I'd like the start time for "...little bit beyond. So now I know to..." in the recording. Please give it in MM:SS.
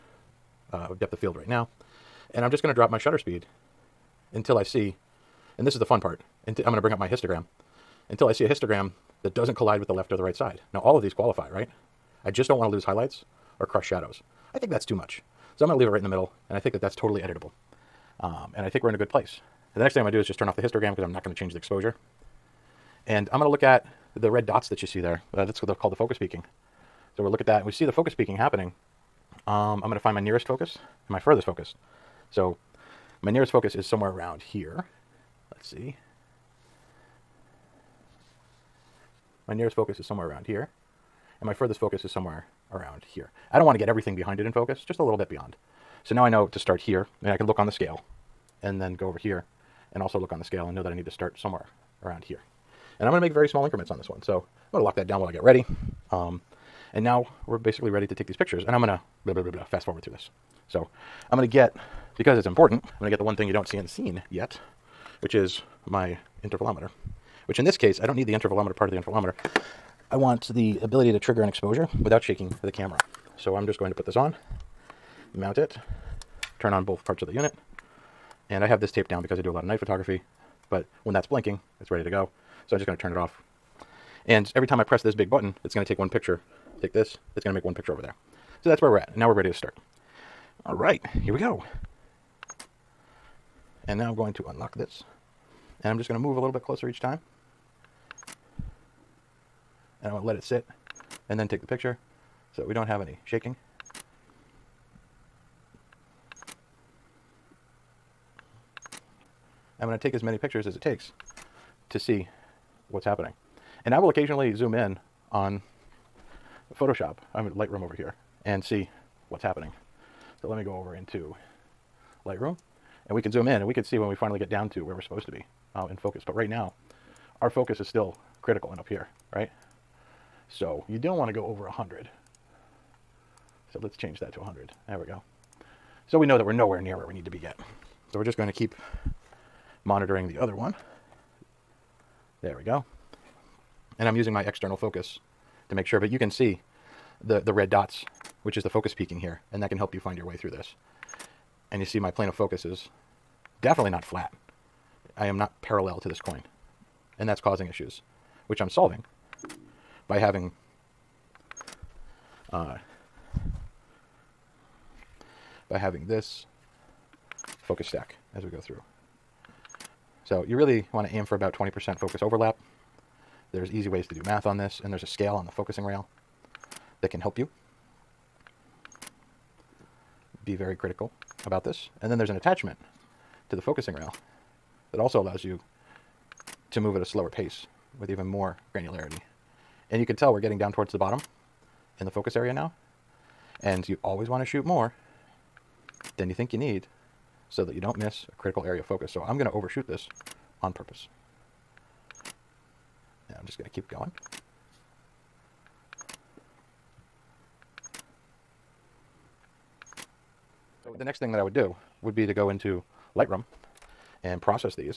00:45.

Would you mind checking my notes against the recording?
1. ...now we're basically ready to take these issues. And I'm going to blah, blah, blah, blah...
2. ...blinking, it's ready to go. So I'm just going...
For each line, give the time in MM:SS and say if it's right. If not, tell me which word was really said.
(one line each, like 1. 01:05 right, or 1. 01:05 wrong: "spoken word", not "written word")
1. 00:57 wrong: "pictures", not "issues"
2. 01:21 right.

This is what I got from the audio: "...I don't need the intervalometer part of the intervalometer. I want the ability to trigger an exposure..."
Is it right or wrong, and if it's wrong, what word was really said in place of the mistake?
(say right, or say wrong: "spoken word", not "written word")
right.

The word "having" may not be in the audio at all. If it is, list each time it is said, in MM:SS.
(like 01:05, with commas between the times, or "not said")
02:40, 02:45.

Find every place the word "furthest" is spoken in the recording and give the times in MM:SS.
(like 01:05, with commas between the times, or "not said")
00:31, 00:41.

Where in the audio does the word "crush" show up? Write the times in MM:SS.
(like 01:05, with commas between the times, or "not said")
00:13.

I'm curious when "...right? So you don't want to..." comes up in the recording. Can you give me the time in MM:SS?
02:09.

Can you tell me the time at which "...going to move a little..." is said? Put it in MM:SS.
01:36.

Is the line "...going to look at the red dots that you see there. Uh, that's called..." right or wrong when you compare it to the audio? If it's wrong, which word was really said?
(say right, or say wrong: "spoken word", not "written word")
right.